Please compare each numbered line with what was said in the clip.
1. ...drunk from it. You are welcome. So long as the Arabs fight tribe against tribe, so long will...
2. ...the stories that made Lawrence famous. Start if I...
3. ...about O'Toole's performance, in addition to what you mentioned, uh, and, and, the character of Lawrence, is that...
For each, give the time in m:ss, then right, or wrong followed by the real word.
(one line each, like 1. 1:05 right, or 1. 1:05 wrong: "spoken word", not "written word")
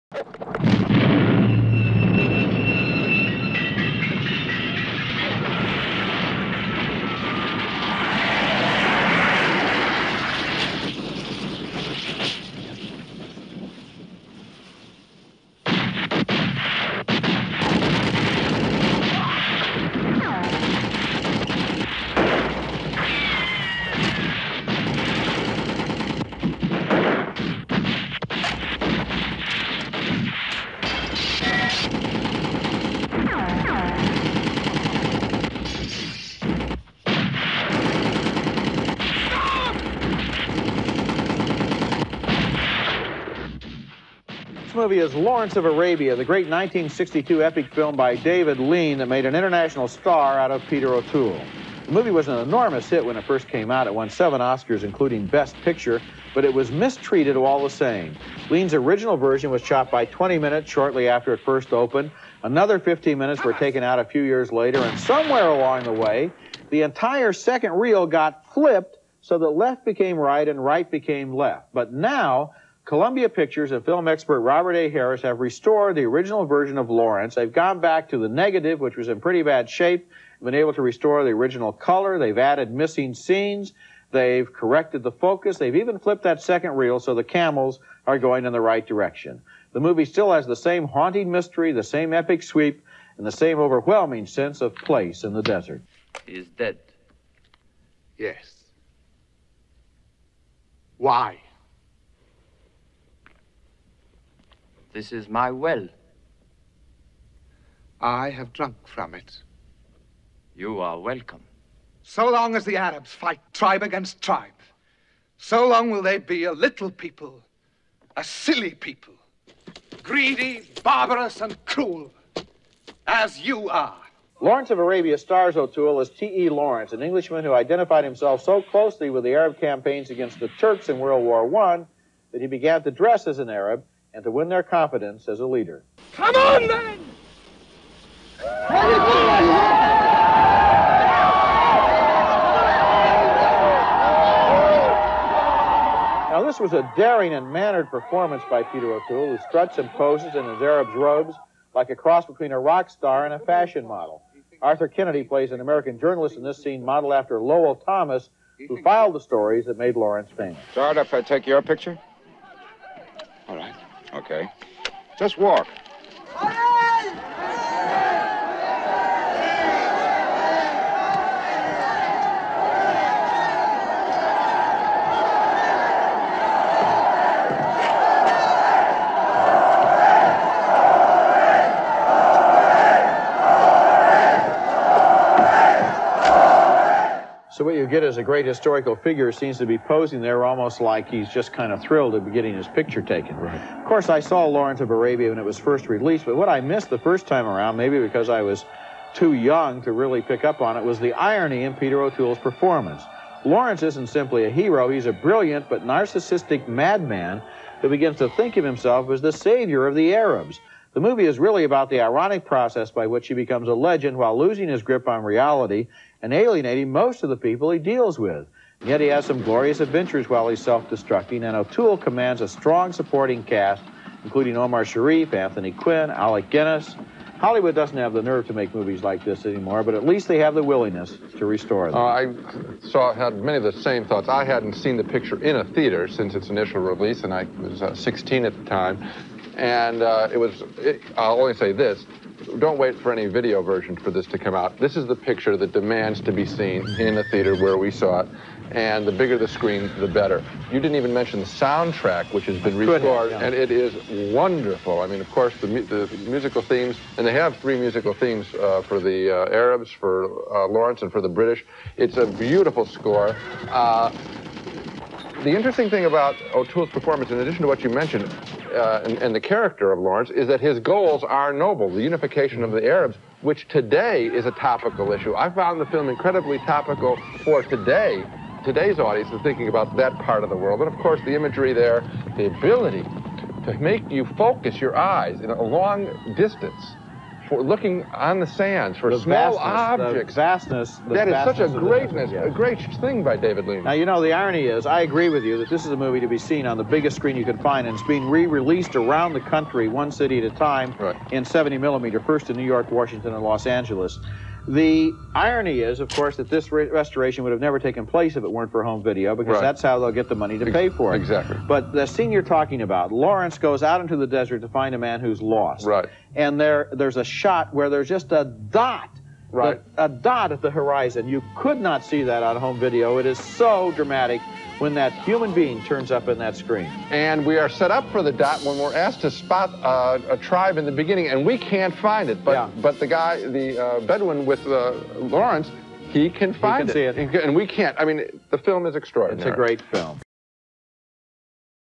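1. 1:48 right
2. 2:39 right
3. 4:26 right.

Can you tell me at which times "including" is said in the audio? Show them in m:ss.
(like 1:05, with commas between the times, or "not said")
0:54, 3:44.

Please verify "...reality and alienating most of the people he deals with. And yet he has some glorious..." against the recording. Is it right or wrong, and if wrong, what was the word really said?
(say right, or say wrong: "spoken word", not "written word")
right.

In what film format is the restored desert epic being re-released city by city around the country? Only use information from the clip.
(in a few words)
70 millimeter.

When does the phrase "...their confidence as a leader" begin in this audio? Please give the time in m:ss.
2:14.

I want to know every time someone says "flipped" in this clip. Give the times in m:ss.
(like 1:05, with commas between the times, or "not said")
1:08, 1:25.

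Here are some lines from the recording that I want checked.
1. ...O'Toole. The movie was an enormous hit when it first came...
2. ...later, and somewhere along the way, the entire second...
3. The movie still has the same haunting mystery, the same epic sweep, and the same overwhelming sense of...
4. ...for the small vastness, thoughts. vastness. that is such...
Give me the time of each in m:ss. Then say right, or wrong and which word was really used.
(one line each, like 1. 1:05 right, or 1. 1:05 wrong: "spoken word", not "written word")
1. 0:50 right
2. 1:04 right
3. 1:29 right
4. 4:48 wrong: "objects", not "thoughts".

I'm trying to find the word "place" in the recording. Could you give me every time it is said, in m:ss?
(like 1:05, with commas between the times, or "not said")
1:34, 5:08.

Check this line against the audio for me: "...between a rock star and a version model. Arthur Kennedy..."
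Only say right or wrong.
wrong.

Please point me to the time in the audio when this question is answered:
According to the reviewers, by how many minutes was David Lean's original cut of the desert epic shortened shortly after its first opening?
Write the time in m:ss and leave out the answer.
1:00.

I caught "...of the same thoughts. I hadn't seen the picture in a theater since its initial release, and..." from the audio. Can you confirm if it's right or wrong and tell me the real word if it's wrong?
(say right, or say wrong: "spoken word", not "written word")
right.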